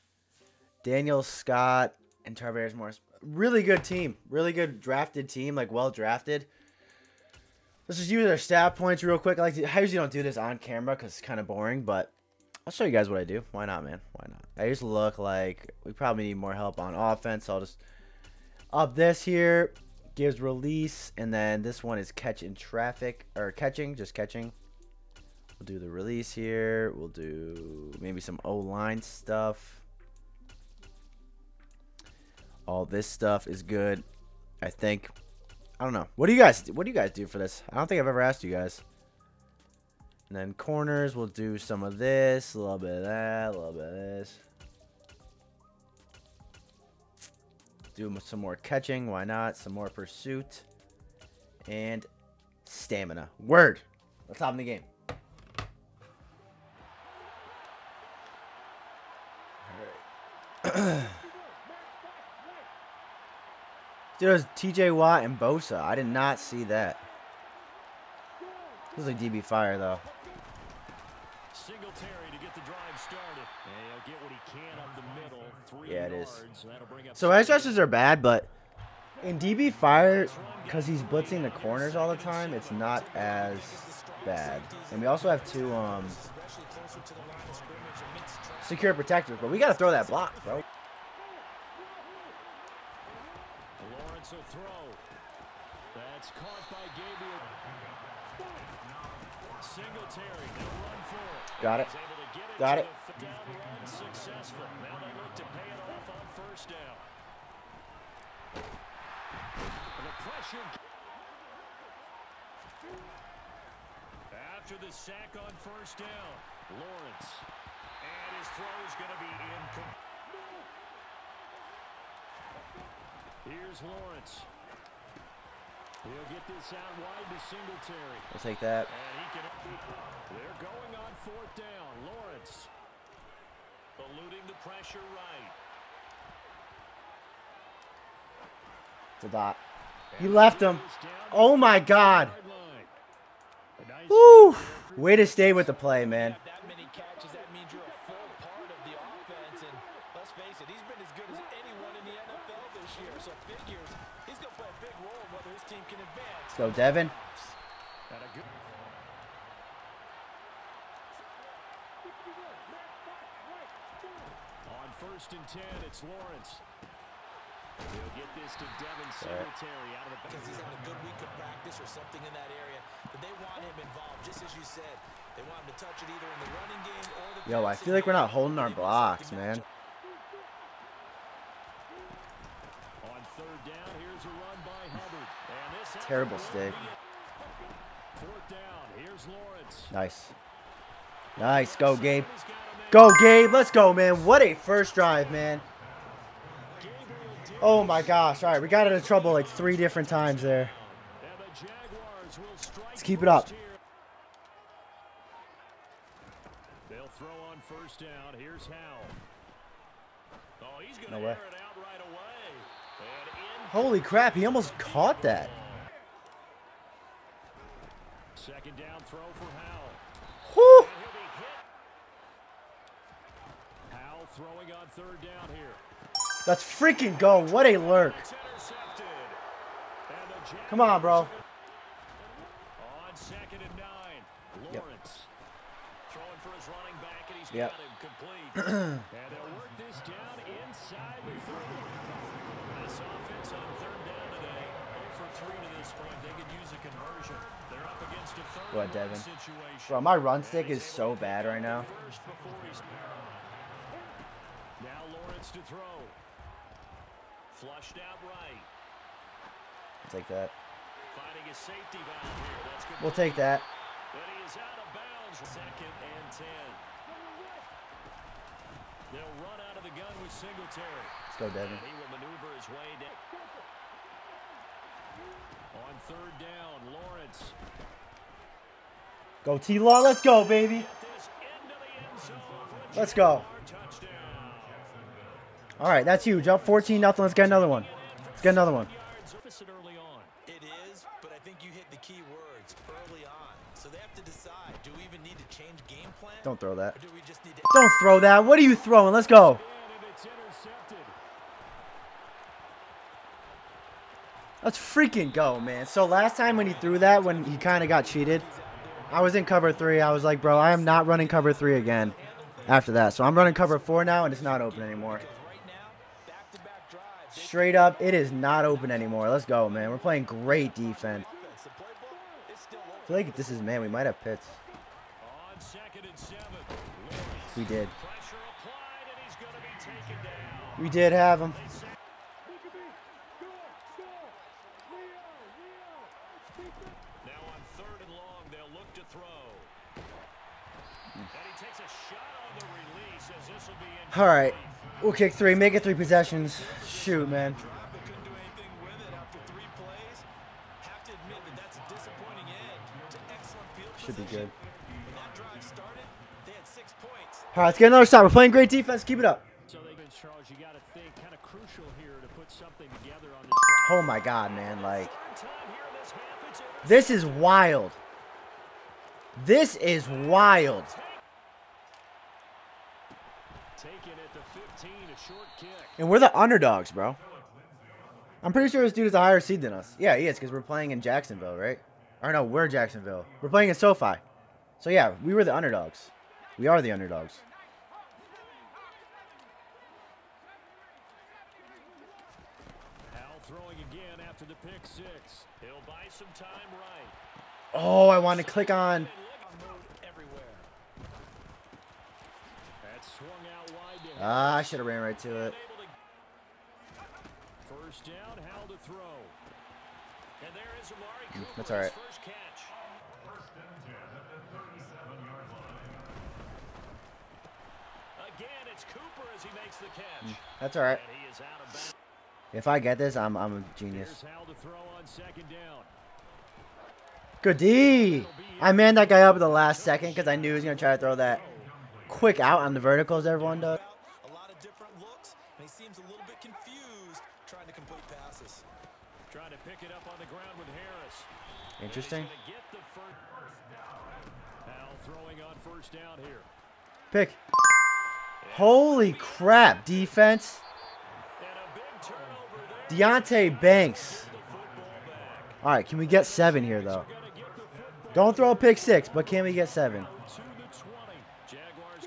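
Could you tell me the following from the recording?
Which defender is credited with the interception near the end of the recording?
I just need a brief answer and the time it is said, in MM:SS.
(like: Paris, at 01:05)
Deonte Banks, at 07:32.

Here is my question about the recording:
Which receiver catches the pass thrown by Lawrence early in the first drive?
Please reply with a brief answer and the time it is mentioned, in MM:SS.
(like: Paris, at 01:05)
Gabriel, at 01:36.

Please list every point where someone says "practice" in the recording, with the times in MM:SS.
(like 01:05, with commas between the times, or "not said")
02:51.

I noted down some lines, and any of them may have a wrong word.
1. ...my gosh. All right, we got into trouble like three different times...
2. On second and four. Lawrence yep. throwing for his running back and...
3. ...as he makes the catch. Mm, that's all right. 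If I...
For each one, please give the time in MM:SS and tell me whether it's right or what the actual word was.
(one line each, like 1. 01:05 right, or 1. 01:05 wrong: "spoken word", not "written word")
1. 03:17 right
2. 03:51 wrong: "nine", not "four"
3. 06:59 right.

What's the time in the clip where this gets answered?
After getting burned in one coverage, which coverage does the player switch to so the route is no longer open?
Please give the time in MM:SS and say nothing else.
05:13.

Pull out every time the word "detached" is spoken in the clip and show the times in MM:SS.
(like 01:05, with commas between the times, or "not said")
not said.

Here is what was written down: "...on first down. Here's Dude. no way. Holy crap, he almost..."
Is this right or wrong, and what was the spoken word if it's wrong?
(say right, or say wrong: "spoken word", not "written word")
wrong: "Howell", not "Dude".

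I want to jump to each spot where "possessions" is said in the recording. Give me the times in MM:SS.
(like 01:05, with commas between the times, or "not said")
05:45.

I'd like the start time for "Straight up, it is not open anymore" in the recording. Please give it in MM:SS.
05:17.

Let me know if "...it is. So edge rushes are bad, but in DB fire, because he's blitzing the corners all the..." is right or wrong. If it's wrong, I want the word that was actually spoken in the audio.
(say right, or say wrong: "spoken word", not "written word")
right.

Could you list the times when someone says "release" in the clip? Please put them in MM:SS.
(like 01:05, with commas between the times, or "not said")
00:20, 00:25.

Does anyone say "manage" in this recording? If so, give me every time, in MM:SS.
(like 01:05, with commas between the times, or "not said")
not said.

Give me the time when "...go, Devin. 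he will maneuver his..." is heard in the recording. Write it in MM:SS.
04:31.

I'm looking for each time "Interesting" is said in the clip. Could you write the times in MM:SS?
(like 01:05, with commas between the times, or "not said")
07:21.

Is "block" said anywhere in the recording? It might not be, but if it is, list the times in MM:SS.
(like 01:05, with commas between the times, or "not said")
01:30, 02:58.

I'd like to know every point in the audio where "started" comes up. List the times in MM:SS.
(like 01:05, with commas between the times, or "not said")
01:12.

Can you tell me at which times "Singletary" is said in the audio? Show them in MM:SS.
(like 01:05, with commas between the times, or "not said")
01:11, 02:49, 04:30.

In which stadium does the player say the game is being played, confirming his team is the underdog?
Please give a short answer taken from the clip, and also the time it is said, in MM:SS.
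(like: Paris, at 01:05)
SoFi, at 06:23.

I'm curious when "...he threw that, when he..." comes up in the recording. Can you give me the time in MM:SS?
05:06.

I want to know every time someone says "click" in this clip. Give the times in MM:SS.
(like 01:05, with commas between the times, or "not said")
06:38.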